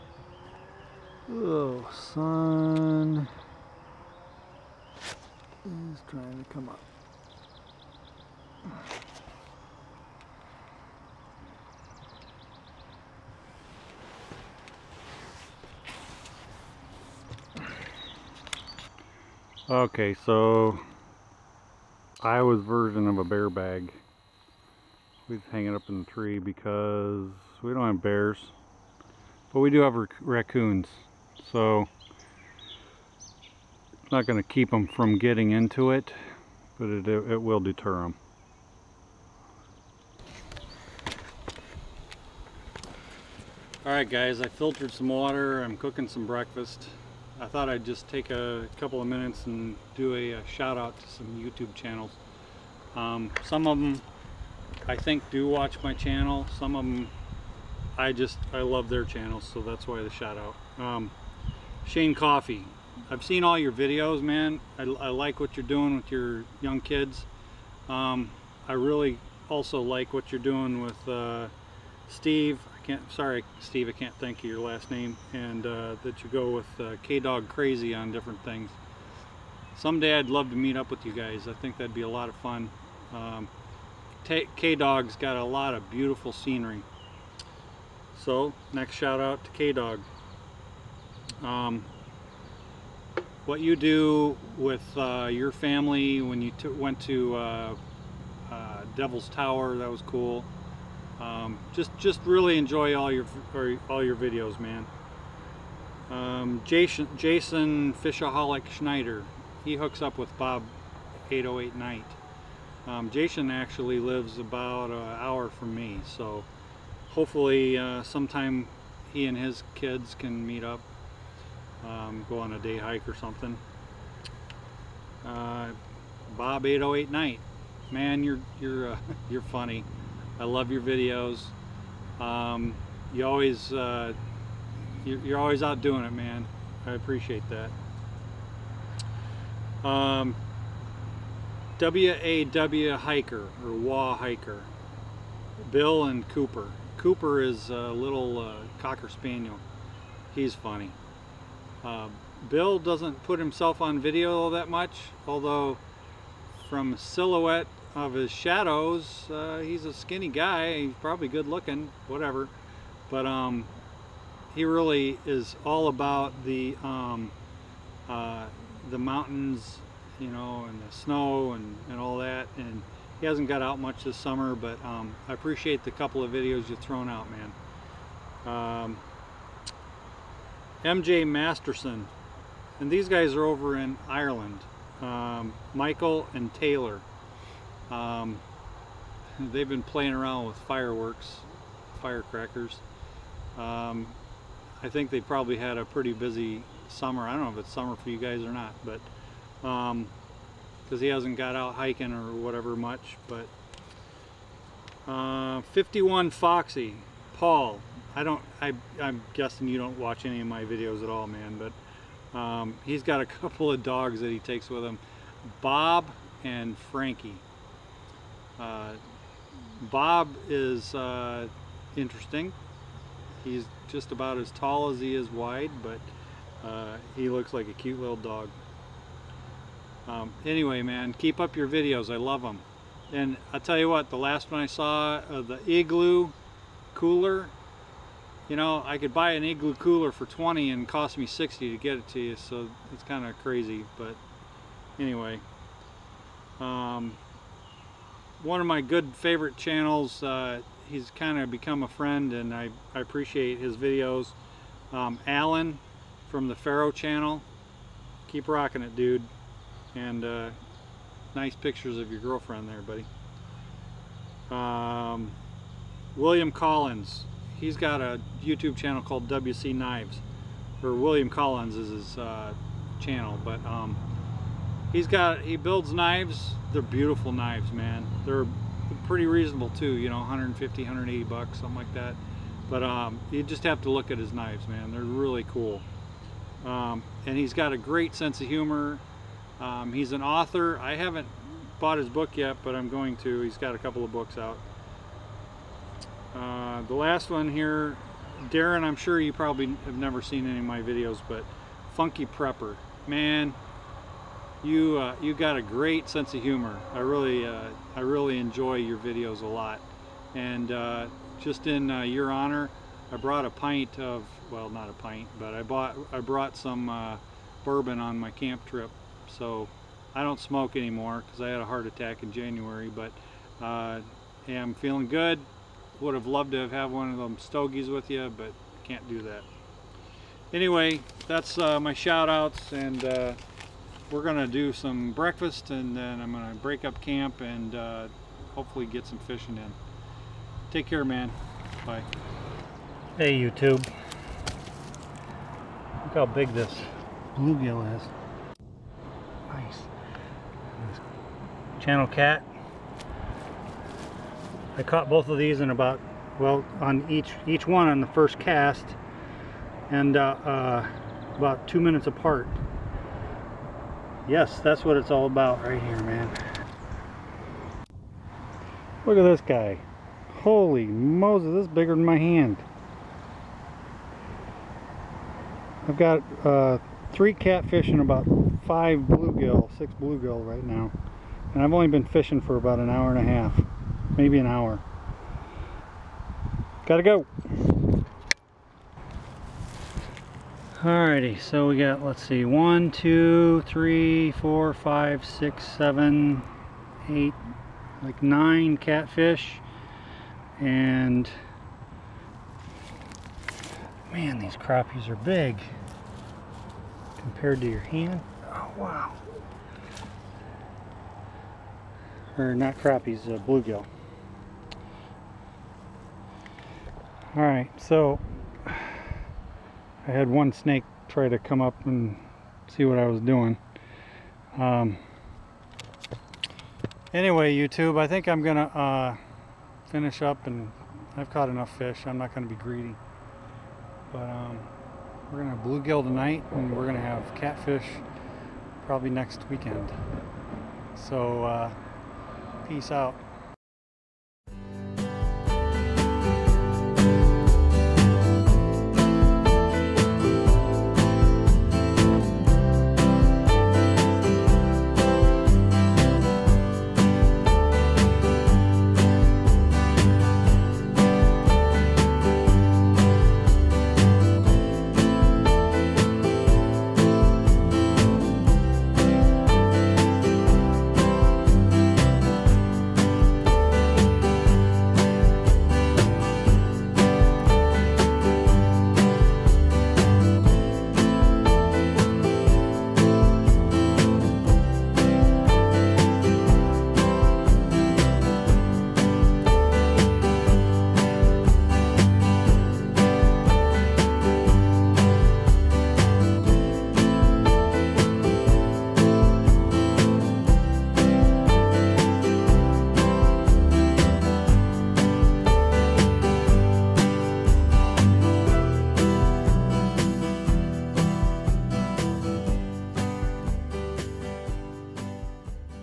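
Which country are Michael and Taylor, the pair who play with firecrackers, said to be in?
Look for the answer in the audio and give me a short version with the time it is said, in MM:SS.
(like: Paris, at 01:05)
Ireland, at 03:04.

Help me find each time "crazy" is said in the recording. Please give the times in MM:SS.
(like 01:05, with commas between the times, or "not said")
01:17, 04:03.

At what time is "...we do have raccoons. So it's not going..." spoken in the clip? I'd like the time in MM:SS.
00:29.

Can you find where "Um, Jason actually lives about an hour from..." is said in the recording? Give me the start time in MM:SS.
01:52.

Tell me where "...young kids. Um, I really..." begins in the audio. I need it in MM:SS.
01:06.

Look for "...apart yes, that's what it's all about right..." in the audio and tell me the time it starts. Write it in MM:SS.
06:02.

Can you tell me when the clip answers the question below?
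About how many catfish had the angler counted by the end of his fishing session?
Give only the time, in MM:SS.
06:38.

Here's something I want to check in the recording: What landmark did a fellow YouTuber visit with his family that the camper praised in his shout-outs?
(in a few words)
Devil's Tower.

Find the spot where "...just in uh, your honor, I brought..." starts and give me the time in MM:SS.
05:11.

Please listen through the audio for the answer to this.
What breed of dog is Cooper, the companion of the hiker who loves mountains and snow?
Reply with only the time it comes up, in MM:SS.
02:28.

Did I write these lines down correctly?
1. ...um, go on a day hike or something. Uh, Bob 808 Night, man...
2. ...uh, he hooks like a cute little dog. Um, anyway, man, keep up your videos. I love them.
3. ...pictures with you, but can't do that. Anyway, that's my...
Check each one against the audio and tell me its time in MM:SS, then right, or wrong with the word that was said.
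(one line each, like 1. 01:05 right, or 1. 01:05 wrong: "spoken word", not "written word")
1. 02:01 right
2. 03:46 wrong: "looks", not "hooks"
3. 05:27 wrong: "stogies", not "pictures".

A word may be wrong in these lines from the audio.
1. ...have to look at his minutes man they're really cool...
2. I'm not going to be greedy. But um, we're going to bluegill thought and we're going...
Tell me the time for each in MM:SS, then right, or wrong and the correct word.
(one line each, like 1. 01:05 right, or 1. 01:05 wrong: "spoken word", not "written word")
1. 04:43 wrong: "knives", not "minutes"
2. 07:12 wrong: "tonight", not "thought".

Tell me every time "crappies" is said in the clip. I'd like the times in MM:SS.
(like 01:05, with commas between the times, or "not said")
06:44, 06:52.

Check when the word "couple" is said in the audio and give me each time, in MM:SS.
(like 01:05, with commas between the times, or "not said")
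00:48, 02:55, 03:33, 04:53.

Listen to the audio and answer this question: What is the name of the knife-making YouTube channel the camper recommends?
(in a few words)
WC Knives.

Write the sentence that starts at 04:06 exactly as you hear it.
Um, one of my good favorite channels.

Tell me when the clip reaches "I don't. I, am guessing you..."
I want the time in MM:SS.
03:28.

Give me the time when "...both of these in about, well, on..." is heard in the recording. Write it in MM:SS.
05:55.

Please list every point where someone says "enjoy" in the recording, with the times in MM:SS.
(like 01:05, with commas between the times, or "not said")
01:42, 05:08.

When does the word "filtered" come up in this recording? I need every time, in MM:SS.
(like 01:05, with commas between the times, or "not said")
00:44.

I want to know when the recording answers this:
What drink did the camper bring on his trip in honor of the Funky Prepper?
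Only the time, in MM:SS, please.
05:17.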